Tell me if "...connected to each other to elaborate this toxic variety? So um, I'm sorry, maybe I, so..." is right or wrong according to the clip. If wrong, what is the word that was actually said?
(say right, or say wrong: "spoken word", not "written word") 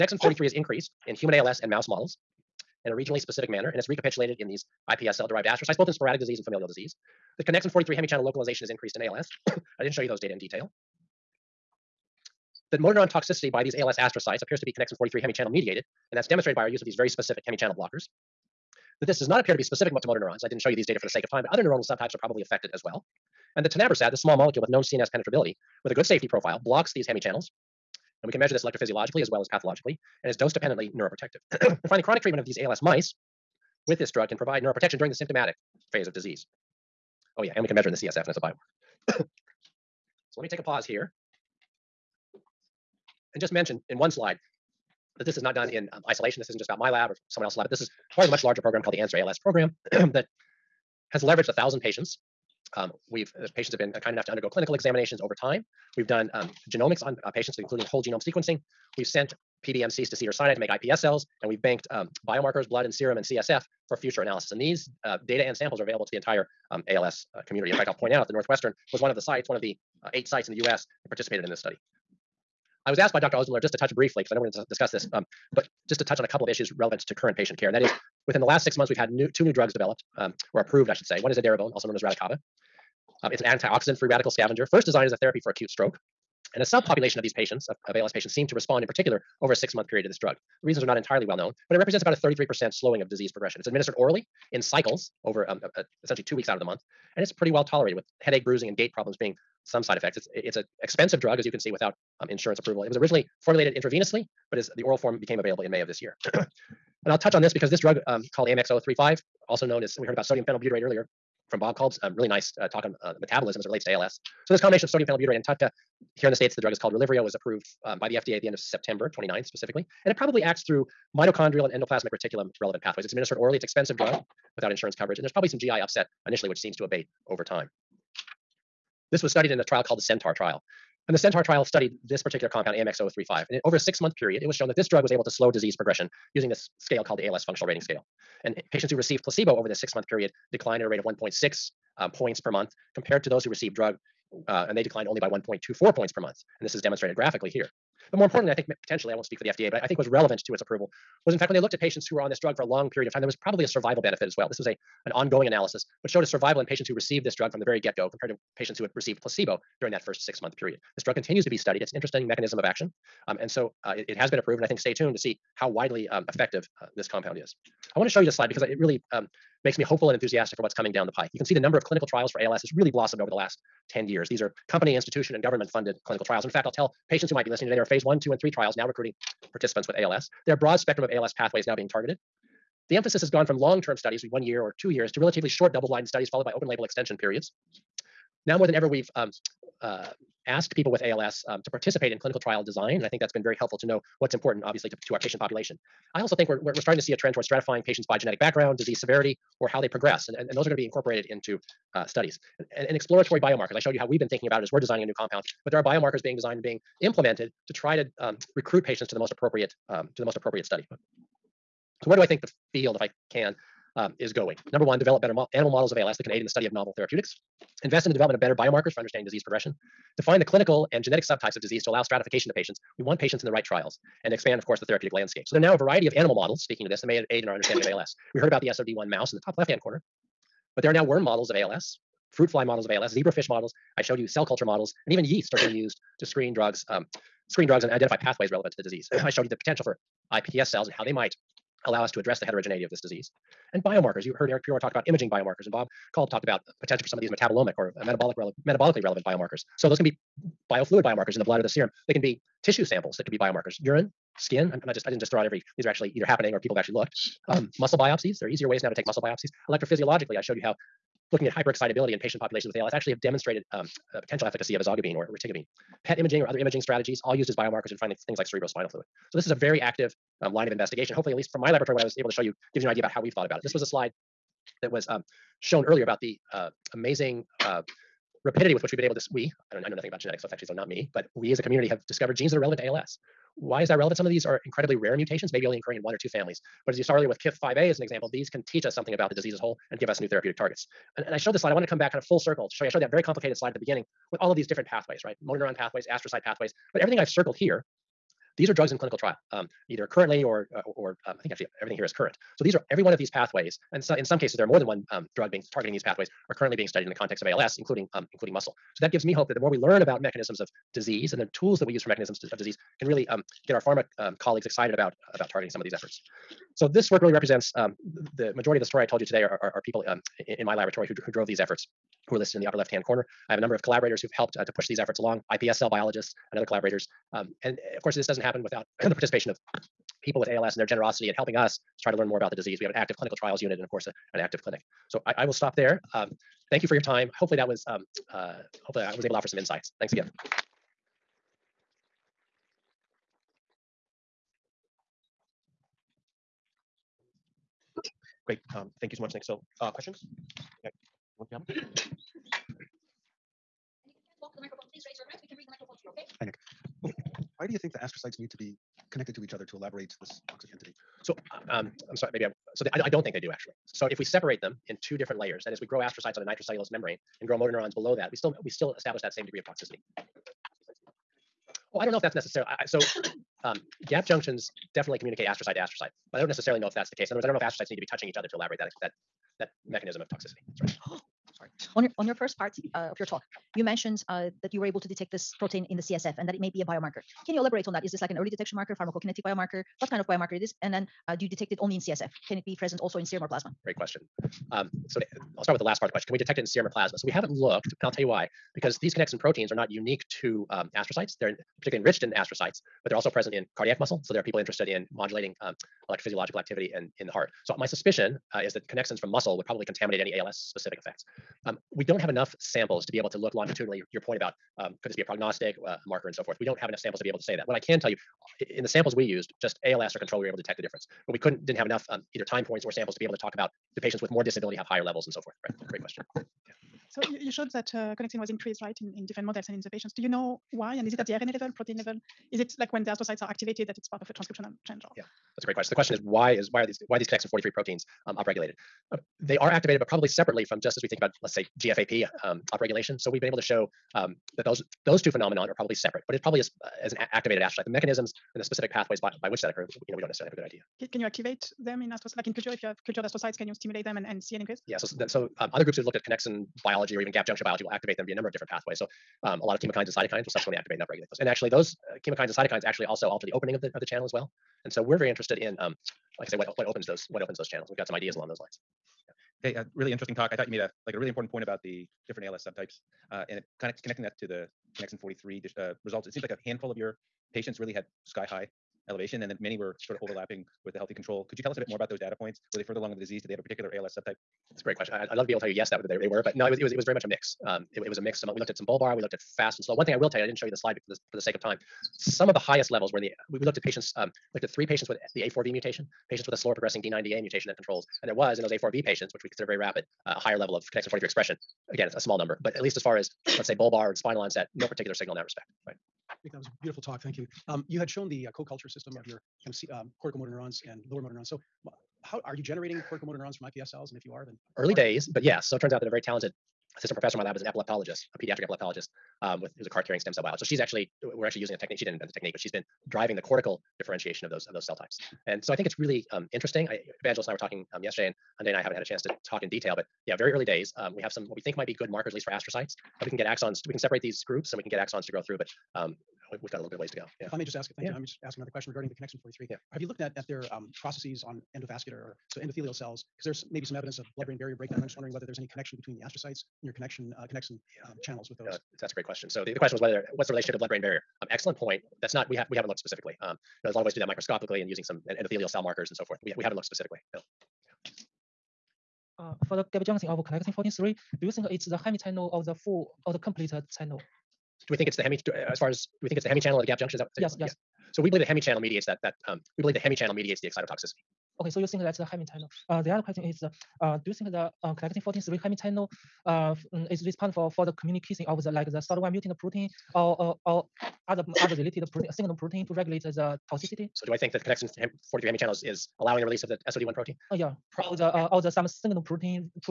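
wrong: "entity", not "variety".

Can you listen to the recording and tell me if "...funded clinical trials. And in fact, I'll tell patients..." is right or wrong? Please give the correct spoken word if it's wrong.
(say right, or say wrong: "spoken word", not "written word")
right.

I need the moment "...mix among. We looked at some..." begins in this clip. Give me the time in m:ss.
8:08.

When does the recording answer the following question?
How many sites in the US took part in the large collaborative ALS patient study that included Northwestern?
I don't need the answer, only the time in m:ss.
1:10.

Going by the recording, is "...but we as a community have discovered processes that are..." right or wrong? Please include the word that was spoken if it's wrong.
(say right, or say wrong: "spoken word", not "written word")
wrong: "genes", not "processes".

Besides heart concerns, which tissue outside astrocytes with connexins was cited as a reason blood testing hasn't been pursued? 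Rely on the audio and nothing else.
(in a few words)
cardiac muscle.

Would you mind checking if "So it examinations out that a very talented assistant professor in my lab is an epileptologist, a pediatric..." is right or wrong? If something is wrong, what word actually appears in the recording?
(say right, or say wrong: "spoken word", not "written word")
wrong: "turns", not "examinations".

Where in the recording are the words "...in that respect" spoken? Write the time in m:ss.
8:25.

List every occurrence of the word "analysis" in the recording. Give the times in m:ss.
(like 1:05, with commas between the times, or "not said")
1:04, 2:35.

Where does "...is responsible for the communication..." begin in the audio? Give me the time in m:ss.
9:37.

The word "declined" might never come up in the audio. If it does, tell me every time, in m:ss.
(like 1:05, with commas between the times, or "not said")
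2:20, 2:24.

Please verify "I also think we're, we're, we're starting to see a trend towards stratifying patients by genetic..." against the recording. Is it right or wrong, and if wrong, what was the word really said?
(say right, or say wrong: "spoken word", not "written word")
right.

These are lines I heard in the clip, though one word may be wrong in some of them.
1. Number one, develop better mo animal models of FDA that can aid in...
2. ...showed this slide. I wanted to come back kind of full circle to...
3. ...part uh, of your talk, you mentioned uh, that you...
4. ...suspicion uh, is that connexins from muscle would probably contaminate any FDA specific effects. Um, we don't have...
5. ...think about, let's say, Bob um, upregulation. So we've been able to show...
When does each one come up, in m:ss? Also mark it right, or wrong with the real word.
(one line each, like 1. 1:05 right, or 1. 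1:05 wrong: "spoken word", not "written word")
1. 3:34 wrong: "ALS", not "FDA"
2. 4:51 right
3. 6:22 right
4. 6:47 wrong: "ALS", not "FDA"
5. 7:21 wrong: "GFAP", not "Bob".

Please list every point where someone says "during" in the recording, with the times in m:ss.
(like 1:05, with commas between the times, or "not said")
0:34, 2:39.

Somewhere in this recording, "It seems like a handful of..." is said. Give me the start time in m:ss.
7:56.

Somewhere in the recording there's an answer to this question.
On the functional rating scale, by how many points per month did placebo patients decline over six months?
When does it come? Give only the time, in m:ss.
2:21.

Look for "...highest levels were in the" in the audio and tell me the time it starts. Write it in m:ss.
8:12.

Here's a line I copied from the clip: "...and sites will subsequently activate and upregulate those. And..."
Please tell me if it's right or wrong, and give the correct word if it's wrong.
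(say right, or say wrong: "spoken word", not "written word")
wrong: "cytokines", not "sites".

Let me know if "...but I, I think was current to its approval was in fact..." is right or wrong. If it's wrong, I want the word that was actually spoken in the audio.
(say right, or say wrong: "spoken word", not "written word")
wrong: "relevant", not "current".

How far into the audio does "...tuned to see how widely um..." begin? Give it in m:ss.
2:44.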